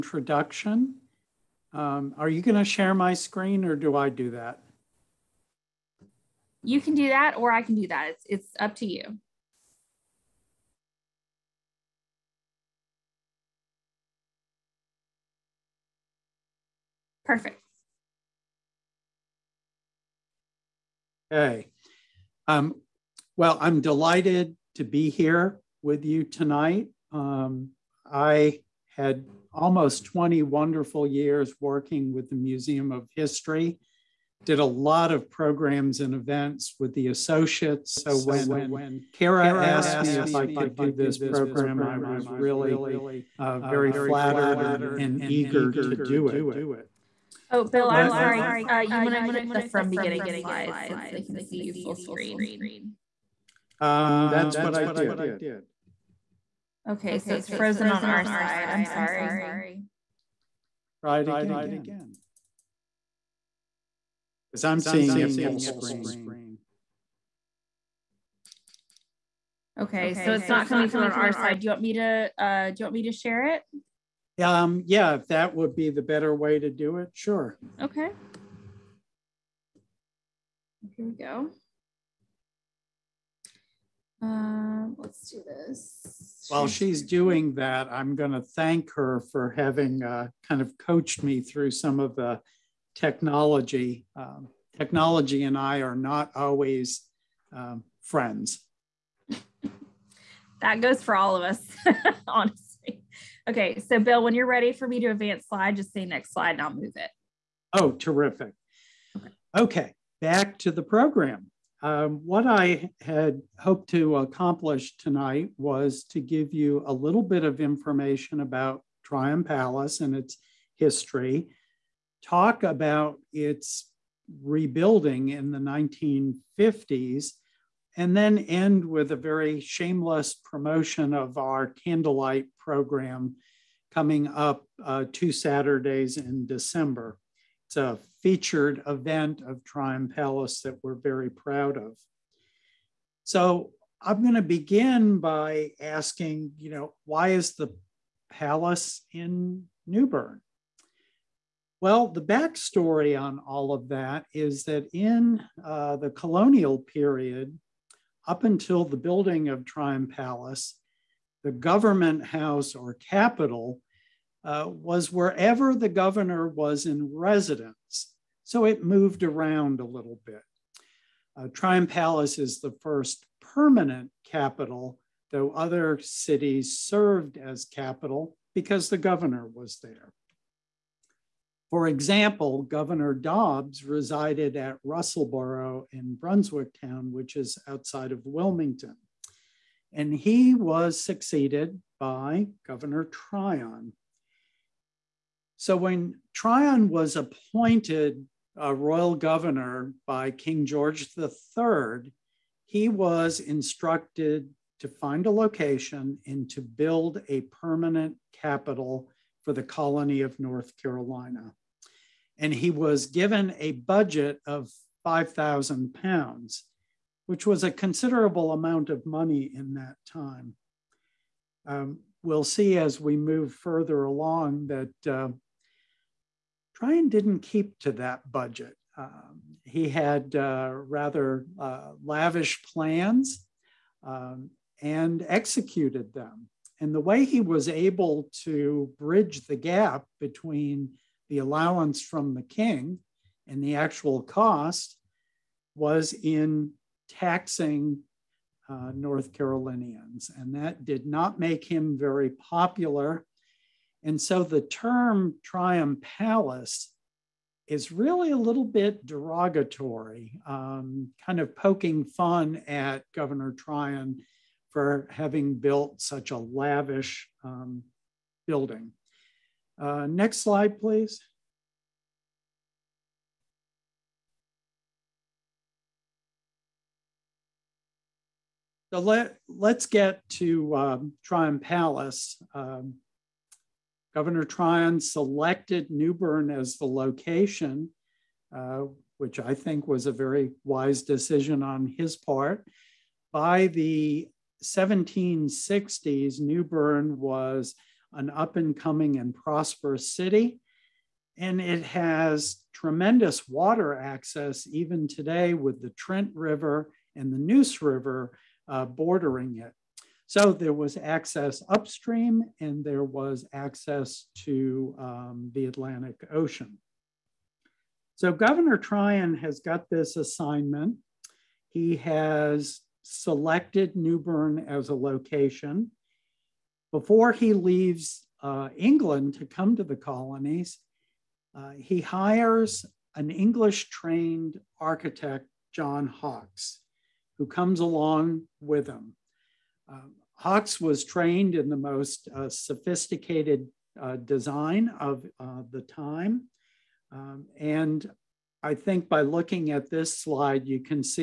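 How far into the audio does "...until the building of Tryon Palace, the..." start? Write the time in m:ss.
2:38.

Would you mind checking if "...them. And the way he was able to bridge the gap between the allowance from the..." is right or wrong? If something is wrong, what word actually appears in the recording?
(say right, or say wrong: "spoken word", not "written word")
right.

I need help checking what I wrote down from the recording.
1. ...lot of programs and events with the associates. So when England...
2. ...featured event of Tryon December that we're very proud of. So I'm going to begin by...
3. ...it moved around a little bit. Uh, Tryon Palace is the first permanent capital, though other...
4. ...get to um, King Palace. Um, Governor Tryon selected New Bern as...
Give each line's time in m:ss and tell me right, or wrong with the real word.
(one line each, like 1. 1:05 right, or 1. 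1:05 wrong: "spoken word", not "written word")
1. 0:34 wrong: "Kara", not "England"
2. 2:18 wrong: "Palace", not "December"
3. 2:48 right
4. 4:39 wrong: "Tryon", not "King".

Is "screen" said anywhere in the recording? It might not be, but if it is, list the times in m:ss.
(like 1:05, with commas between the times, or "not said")
0:03, 0:51, 1:05.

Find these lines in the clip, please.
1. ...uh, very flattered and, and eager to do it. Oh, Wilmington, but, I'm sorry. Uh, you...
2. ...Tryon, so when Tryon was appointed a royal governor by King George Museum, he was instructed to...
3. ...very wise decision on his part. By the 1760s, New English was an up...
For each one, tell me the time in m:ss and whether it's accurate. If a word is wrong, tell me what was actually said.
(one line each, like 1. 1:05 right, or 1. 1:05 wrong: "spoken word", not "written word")
1. 0:43 wrong: "Bill", not "Wilmington"
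2. 3:13 wrong: "III", not "Museum"
3. 4:50 wrong: "Bern", not "English".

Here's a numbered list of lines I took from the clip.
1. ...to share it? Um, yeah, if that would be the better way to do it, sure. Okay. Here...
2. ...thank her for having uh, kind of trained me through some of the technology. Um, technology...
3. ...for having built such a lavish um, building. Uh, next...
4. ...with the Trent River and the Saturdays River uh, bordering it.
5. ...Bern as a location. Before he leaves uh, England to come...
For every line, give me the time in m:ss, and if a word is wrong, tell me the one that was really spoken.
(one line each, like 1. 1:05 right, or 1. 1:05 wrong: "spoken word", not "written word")
1. 1:13 right
2. 1:28 wrong: "coached", not "trained"
3. 4:24 right
4. 5:05 wrong: "Neuse", not "Saturdays"
5. 5:24 right.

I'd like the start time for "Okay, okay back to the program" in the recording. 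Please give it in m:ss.
1:49.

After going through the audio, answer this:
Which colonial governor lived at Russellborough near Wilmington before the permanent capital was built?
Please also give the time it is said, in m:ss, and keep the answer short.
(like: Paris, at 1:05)
Dobbs, at 3:03.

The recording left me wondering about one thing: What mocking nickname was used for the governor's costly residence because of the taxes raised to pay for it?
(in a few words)
Triumph Palace.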